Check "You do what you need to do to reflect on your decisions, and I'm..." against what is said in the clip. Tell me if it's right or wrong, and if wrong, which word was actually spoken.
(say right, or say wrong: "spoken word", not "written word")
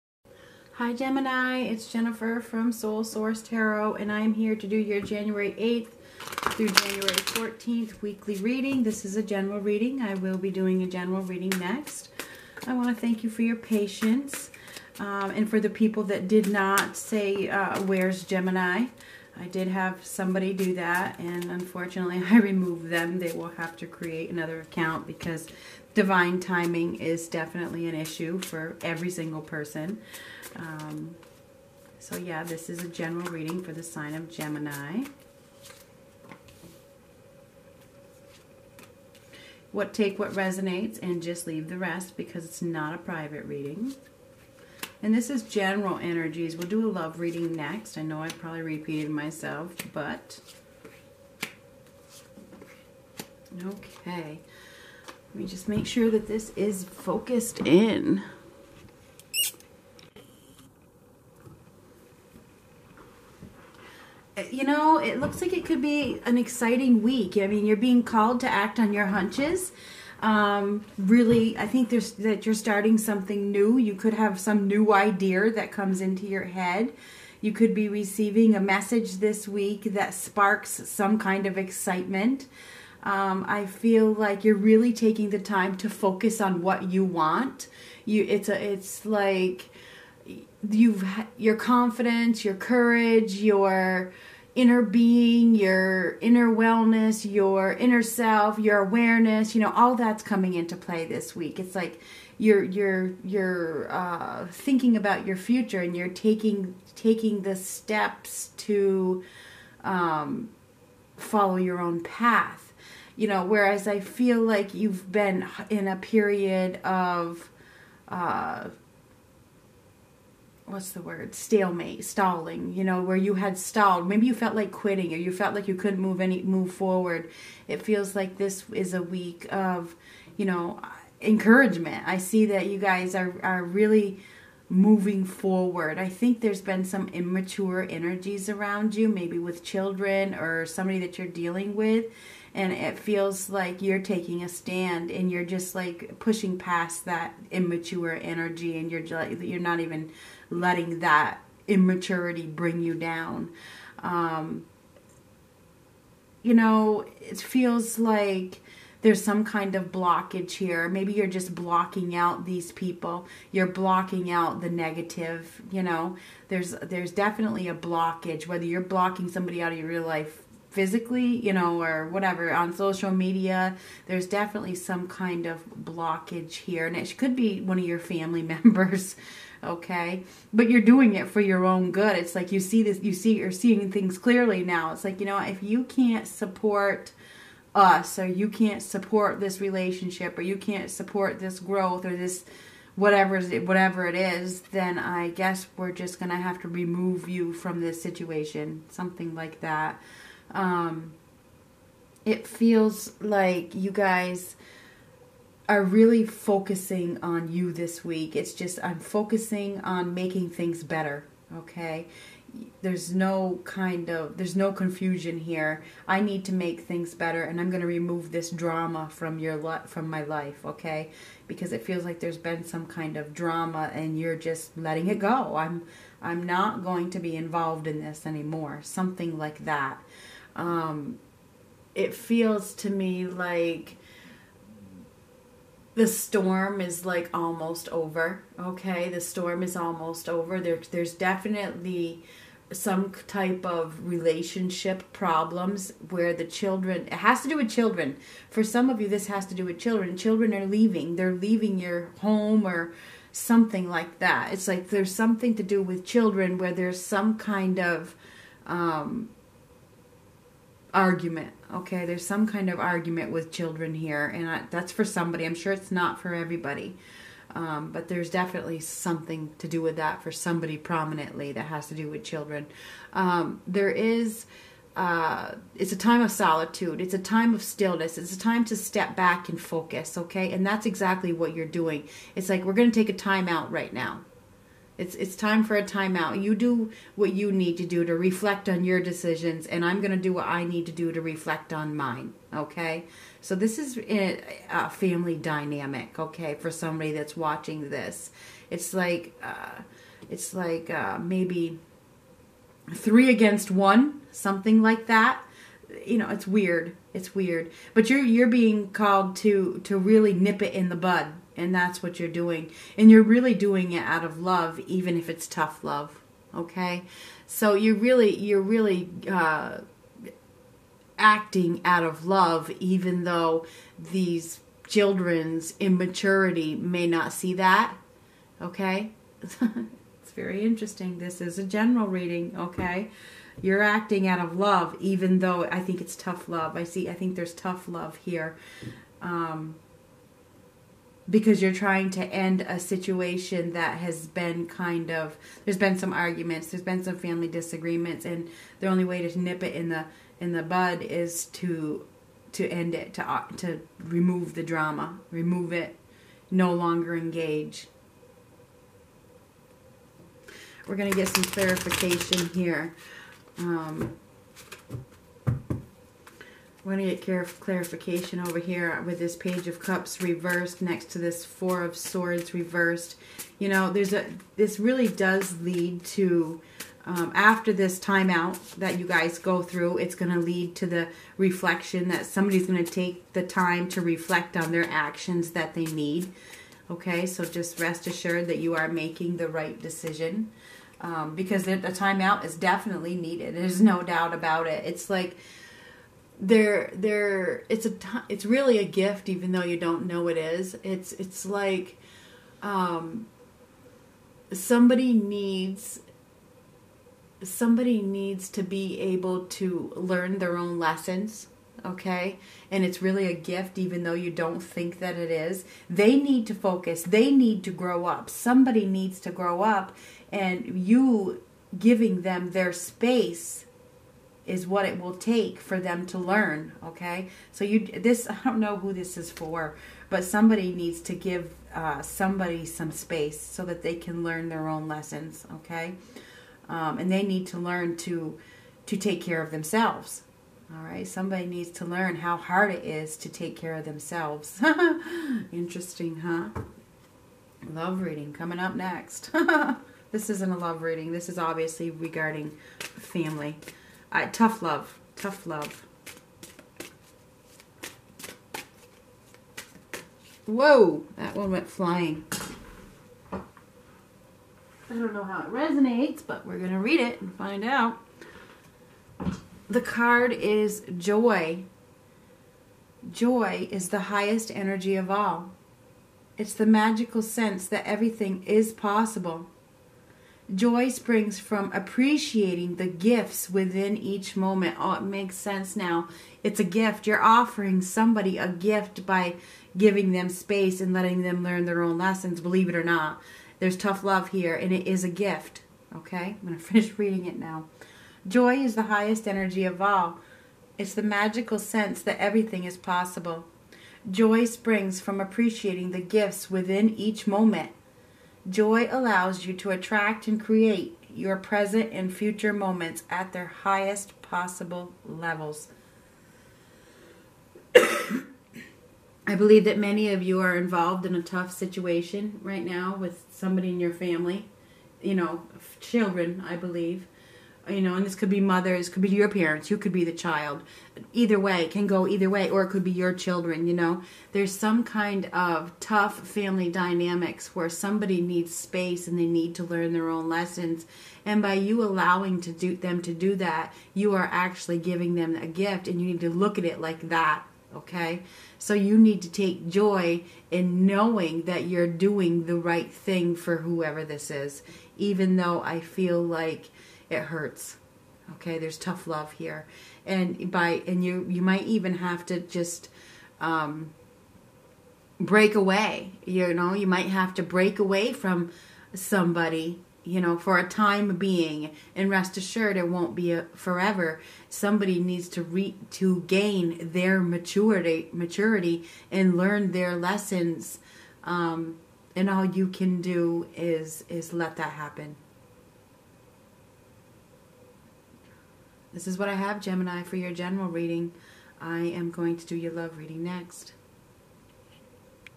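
right.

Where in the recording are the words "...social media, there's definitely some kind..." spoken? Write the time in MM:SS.
02:52.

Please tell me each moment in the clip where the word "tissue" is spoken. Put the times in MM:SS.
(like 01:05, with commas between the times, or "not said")
not said.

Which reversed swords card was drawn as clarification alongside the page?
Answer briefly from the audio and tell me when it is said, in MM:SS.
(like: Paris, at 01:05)
Four of Swords, at 06:11.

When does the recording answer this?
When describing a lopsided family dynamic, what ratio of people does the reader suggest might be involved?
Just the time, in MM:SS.
05:02.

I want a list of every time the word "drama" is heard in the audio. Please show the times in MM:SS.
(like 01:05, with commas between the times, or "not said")
03:38, 03:43, 05:54.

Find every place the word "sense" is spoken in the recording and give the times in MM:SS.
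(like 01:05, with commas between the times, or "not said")
07:57, 08:05, 08:21.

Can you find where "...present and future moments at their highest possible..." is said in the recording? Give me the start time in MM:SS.
08:31.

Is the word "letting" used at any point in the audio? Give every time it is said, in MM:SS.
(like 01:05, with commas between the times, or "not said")
02:30, 03:44, 08:10.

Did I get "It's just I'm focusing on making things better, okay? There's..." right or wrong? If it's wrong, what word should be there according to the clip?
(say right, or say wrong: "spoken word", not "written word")
right.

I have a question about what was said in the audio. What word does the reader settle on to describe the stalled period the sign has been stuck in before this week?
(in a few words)
Stalemate.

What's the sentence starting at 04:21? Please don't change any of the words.
Okay, there's some kind of argument with children here, and I, that's for somebody.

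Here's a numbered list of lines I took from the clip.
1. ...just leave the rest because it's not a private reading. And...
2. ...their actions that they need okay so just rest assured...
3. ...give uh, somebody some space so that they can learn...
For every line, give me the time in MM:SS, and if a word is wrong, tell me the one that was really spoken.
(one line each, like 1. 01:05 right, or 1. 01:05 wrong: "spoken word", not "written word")
1. 00:41 right
2. 06:24 right
3. 07:11 right.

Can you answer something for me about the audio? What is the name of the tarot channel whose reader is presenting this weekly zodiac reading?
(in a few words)
Soul Source Tarot.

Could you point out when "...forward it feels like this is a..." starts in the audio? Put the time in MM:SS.
02:06.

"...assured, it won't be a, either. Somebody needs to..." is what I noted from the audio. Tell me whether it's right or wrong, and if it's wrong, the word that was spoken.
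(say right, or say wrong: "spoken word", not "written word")
wrong: "forever", not "either".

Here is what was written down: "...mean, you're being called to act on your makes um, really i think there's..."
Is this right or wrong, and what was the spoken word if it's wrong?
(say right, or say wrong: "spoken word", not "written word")
wrong: "hunches", not "makes".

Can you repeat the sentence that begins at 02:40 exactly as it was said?
Maybe you're just blocking out these people.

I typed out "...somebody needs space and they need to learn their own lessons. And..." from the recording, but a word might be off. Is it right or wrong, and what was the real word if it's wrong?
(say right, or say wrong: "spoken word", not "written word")
right.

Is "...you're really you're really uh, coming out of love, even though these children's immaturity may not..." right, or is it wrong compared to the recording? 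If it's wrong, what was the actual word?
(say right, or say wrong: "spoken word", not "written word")
wrong: "acting", not "coming".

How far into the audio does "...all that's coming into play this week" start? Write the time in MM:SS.
01:39.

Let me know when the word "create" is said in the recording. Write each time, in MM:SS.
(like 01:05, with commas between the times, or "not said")
00:23, 08:30.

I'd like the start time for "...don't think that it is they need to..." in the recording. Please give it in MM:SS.
06:54.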